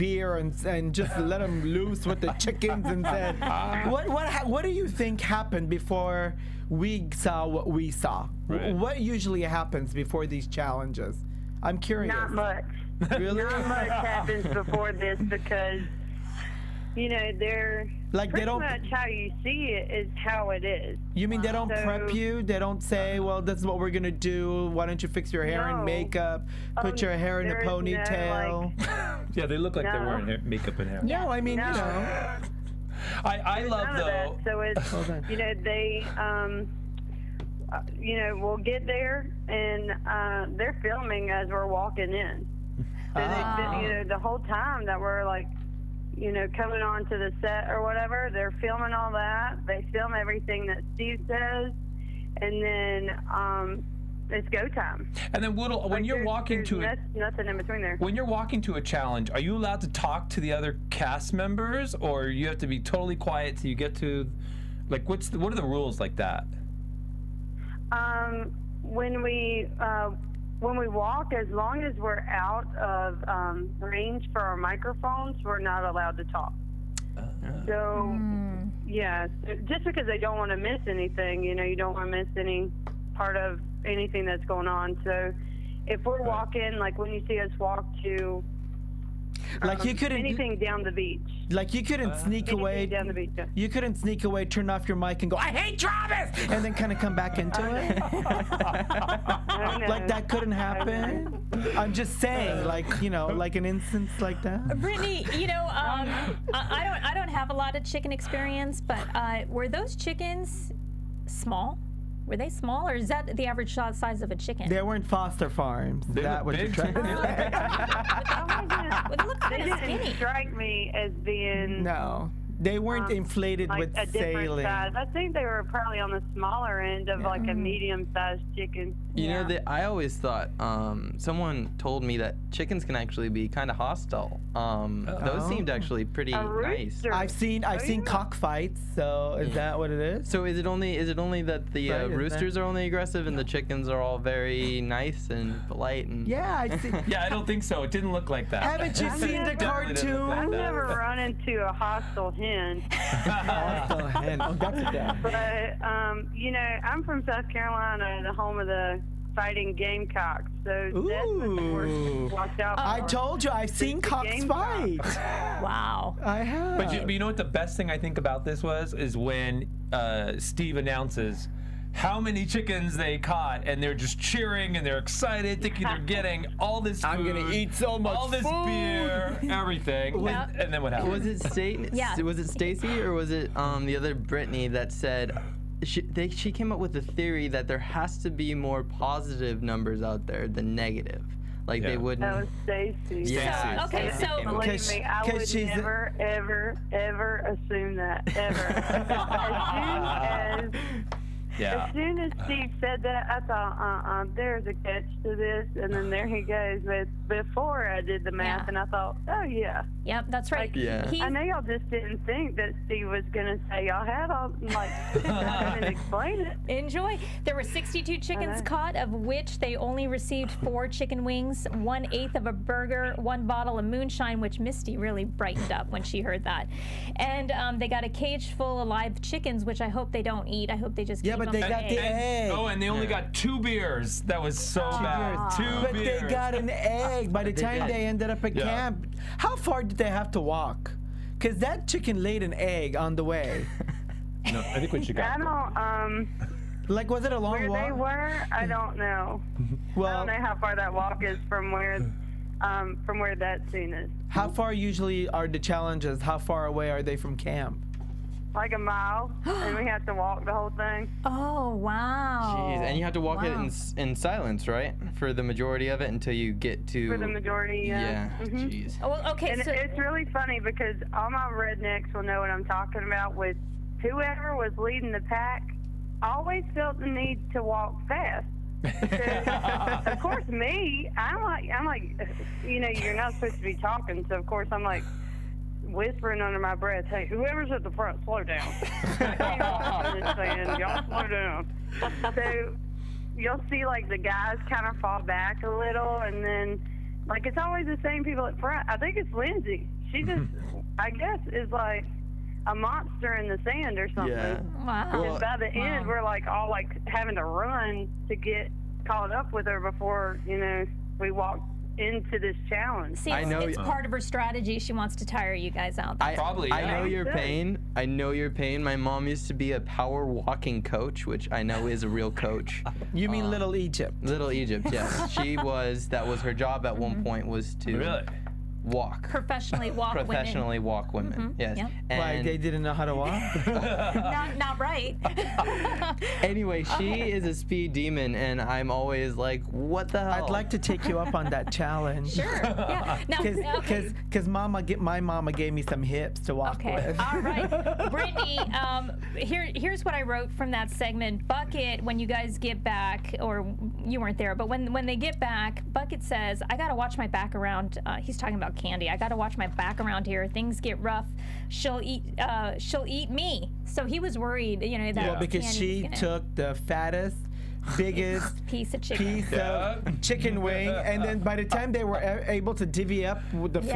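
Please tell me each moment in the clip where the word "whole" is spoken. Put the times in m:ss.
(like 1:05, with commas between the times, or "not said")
0:44, 4:20.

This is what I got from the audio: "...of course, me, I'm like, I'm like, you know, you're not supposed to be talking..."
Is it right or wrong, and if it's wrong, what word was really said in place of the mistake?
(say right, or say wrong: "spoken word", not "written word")
right.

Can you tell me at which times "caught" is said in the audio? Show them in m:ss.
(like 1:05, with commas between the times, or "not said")
2:53, 3:38, 5:09.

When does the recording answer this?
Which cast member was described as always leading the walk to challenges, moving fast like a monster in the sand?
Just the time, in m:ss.
4:59.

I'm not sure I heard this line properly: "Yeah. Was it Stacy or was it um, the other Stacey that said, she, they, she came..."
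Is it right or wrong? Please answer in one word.
wrong.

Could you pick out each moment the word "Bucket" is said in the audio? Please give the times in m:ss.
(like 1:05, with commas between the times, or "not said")
5:51, 5:55.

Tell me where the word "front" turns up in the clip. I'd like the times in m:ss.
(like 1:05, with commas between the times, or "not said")
4:47, 4:58.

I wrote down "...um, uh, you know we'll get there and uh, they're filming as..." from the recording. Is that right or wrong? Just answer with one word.
right.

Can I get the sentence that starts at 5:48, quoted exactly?
Brittany, um, here, here's what I wrote from that segment.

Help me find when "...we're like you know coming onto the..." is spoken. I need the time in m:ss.
0:44.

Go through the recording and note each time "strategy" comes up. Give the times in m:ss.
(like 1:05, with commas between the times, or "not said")
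5:14.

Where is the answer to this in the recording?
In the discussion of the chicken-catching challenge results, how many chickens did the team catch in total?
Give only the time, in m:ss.
3:37.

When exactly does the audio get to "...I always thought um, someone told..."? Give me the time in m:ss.
2:09.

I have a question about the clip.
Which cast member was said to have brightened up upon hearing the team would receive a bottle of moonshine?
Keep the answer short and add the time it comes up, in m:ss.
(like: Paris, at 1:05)
Misty, at 3:44.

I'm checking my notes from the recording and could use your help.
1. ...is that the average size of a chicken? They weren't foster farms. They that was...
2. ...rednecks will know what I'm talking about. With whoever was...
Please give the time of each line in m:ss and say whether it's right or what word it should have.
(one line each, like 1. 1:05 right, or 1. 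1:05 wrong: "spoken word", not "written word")
1. 1:52 right
2. 4:31 right.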